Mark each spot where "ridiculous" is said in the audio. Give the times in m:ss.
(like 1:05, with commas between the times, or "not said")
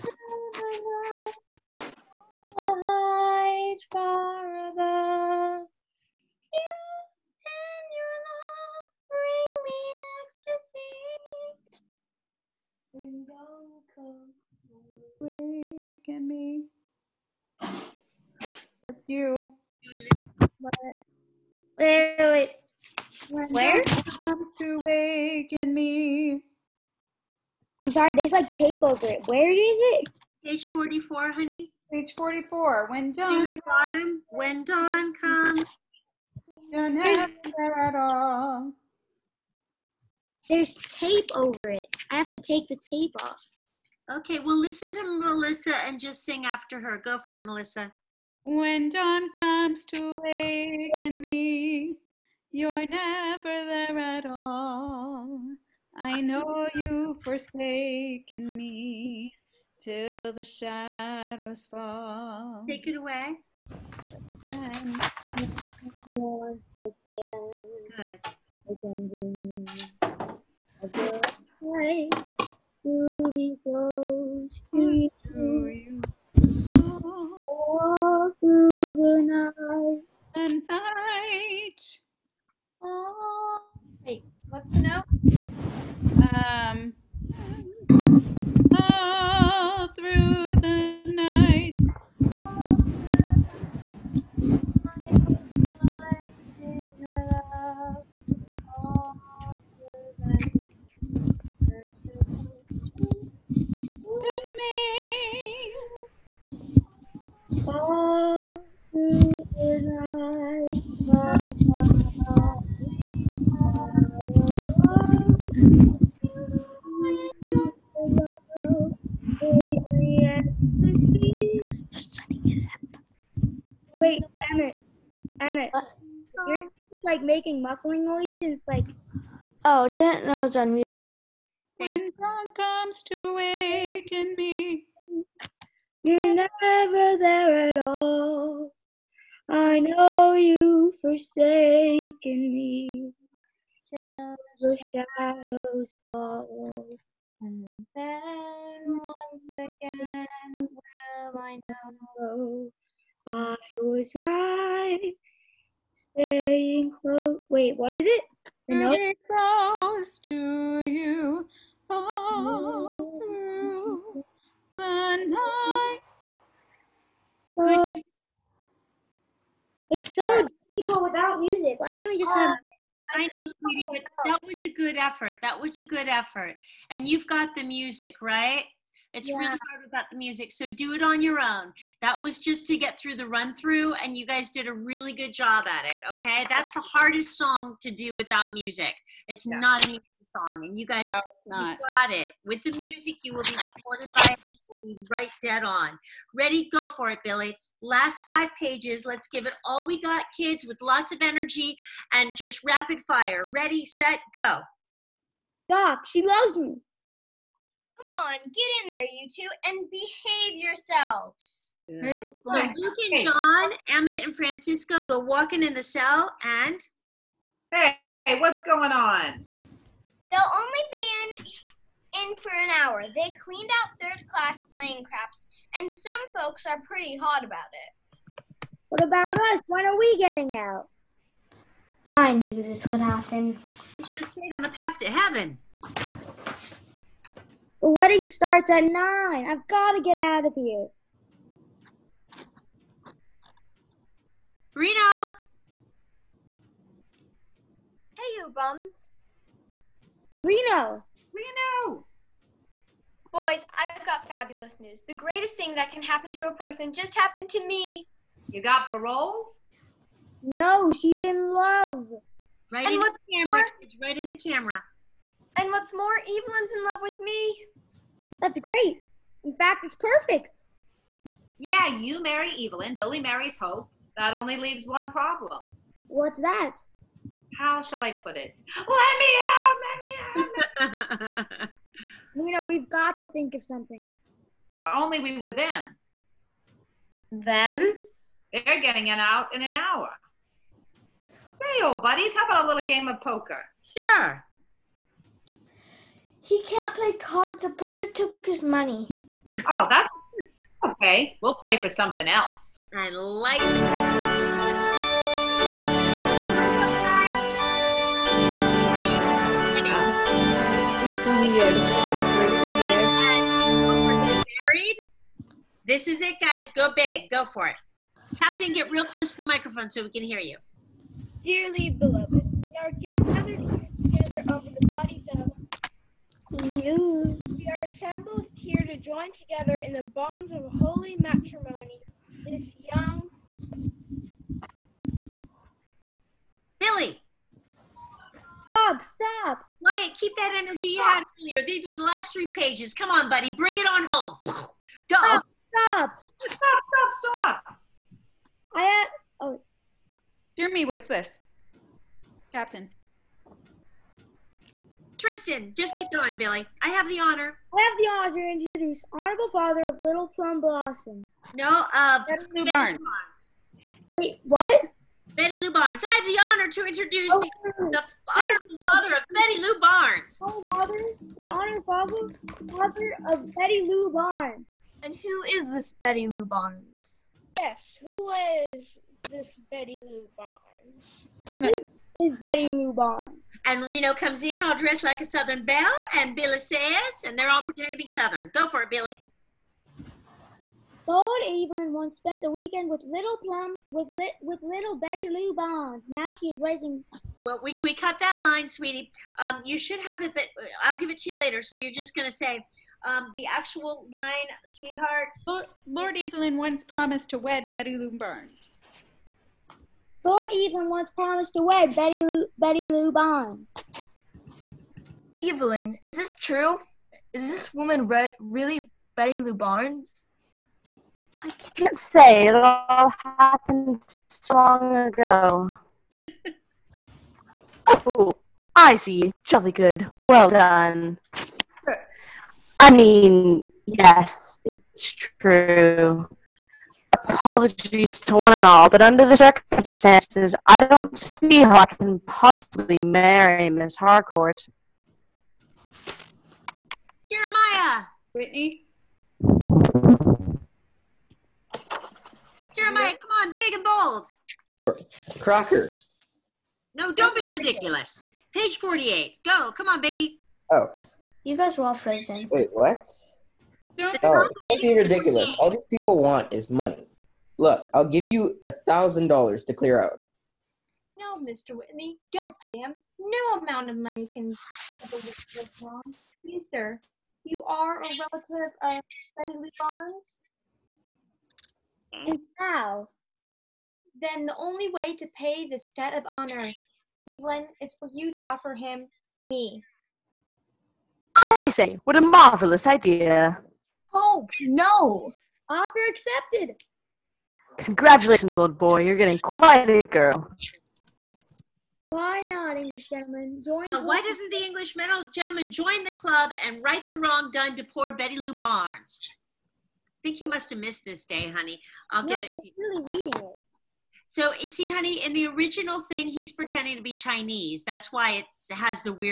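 7:37, 7:44.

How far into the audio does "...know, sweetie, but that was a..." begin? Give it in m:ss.
2:53.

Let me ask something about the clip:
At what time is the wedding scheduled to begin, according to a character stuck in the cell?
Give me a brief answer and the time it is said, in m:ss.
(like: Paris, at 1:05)
9, at 3:58.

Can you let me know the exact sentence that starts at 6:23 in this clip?
And Reno comes in all dressed like a Southern belle, and Billy says, and they're all pretending to be Southern.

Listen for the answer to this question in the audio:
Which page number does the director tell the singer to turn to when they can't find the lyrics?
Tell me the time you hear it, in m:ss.
0:30.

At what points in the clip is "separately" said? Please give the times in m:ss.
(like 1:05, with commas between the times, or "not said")
not said.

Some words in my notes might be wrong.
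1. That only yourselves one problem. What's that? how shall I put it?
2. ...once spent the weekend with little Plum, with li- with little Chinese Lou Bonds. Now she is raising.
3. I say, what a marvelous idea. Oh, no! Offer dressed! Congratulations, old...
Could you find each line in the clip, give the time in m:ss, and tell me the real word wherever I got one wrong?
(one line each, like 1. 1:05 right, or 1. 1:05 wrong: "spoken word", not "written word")
1. 4:34 wrong: "leaves", not "yourselves"
2. 6:31 wrong: "Betty", not "Chinese"
3. 8:11 wrong: "accepted", not "dressed".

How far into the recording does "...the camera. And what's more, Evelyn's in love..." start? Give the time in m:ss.
4:24.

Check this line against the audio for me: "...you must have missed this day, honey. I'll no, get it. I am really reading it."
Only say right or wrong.
right.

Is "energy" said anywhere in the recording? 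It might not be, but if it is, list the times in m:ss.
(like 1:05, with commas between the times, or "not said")
3:21, 5:40.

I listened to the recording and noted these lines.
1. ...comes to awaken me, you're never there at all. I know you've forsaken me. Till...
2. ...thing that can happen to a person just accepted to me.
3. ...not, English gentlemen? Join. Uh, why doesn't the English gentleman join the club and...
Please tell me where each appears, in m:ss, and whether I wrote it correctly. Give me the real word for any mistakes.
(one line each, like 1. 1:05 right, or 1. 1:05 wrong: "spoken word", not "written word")
1. 2:12 wrong: "waken", not "awaken"
2. 4:15 wrong: "happened", not "accepted"
3. 8:22 right.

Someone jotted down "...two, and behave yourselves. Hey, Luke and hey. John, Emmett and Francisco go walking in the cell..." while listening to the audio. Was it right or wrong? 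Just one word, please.
right.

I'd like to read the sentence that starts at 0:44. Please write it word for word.
Okay, well, listen to Melissa and just sing after her.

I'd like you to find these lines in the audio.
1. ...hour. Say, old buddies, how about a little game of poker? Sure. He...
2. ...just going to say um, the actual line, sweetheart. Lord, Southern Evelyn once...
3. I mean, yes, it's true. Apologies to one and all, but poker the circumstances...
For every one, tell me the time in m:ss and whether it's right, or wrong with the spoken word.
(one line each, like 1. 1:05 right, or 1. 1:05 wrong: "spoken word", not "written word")
1. 4:49 right
2. 6:41 wrong: "Lord", not "Southern"
3. 7:12 wrong: "under", not "poker".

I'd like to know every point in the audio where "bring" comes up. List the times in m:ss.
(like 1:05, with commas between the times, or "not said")
0:09, 5:43.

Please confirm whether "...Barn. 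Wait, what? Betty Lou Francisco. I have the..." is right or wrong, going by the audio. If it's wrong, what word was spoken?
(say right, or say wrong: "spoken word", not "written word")
wrong: "Barnes", not "Francisco".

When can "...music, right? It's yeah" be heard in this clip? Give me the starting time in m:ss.
2:57.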